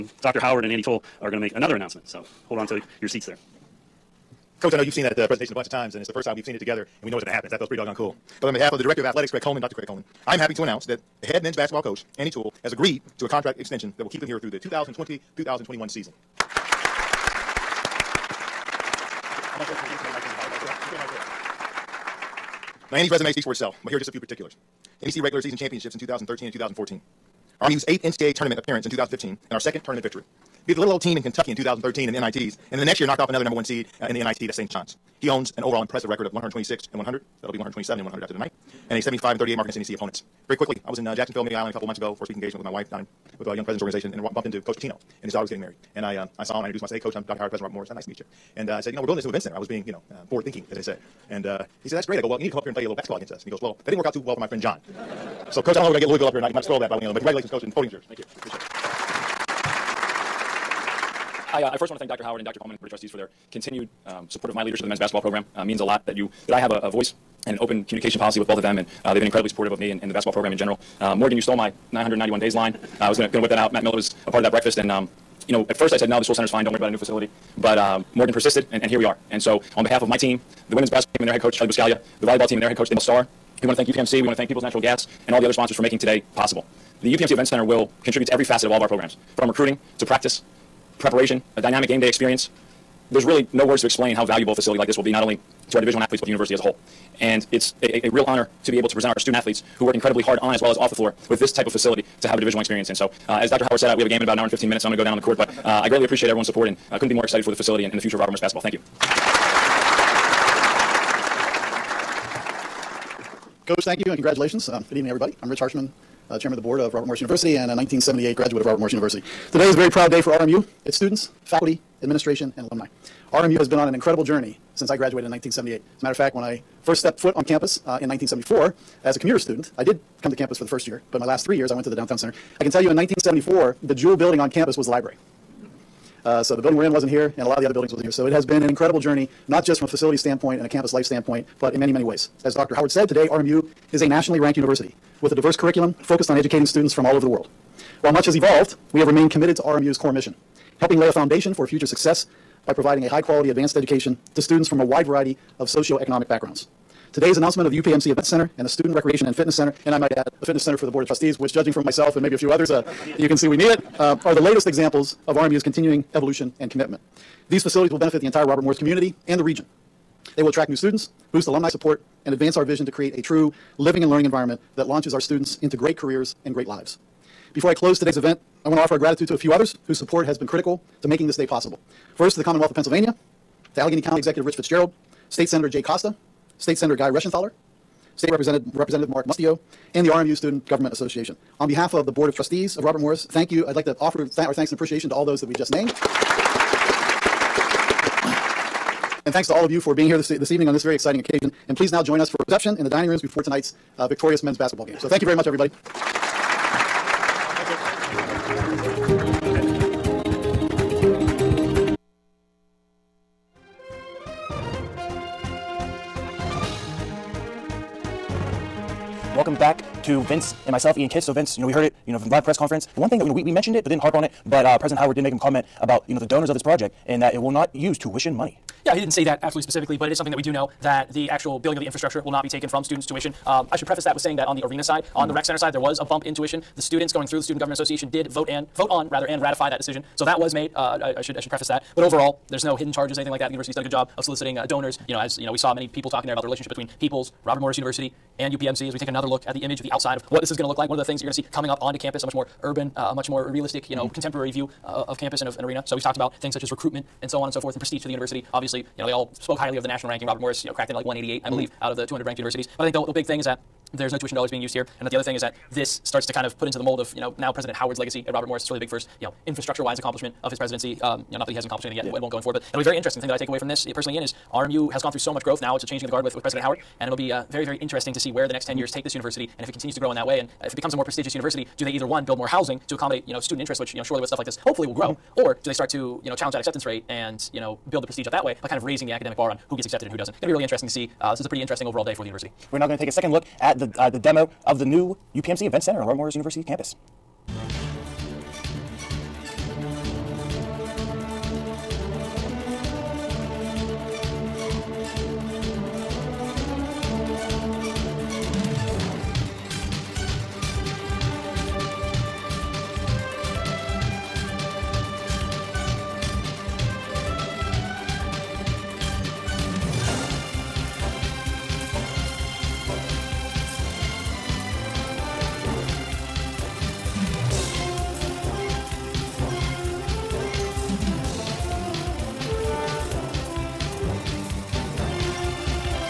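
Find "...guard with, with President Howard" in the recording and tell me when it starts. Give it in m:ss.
4:36.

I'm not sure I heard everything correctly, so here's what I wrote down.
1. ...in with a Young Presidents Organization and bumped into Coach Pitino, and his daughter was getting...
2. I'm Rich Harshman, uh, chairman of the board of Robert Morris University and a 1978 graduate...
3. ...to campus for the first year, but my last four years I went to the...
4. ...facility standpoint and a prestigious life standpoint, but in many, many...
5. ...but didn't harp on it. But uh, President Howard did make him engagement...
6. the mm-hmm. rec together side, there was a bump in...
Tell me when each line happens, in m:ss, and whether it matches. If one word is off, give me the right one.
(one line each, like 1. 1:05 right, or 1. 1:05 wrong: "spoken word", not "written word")
1. 0:42 right
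2. 1:55 right
3. 2:10 wrong: "three", not "four"
4. 2:19 wrong: "campus", not "prestigious"
5. 3:43 wrong: "comment", not "engagement"
6. 3:55 wrong: "center", not "together".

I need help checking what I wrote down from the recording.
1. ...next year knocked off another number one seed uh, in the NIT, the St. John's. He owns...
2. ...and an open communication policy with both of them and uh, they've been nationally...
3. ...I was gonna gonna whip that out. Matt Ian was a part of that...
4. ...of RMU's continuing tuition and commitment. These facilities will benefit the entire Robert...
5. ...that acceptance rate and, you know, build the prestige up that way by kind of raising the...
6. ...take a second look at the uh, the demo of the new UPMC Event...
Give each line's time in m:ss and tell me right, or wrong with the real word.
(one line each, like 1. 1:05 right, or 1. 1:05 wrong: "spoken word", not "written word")
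1. 0:32 right
2. 1:07 wrong: "incredibly", not "nationally"
3. 1:13 wrong: "Miller", not "Ian"
4. 2:45 wrong: "evolution", not "tuition"
5. 4:46 right
6. 4:52 right.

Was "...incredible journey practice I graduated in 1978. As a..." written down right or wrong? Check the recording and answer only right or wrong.
wrong.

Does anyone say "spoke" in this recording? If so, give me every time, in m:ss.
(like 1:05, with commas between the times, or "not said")
4:19.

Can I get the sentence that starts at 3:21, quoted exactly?
And please now join us for reception in the dining rooms before tonight's uh, victorious men's basketball game.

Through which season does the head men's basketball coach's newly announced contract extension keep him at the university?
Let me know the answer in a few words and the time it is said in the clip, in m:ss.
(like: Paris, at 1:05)
2020-2021, at 0:14.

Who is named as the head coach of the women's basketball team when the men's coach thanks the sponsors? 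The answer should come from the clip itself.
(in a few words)
Charlie Buscaglia.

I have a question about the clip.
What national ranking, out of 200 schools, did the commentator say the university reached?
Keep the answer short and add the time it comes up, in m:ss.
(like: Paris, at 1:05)
188, at 4:21.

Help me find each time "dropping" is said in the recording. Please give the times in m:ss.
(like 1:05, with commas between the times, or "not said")
not said.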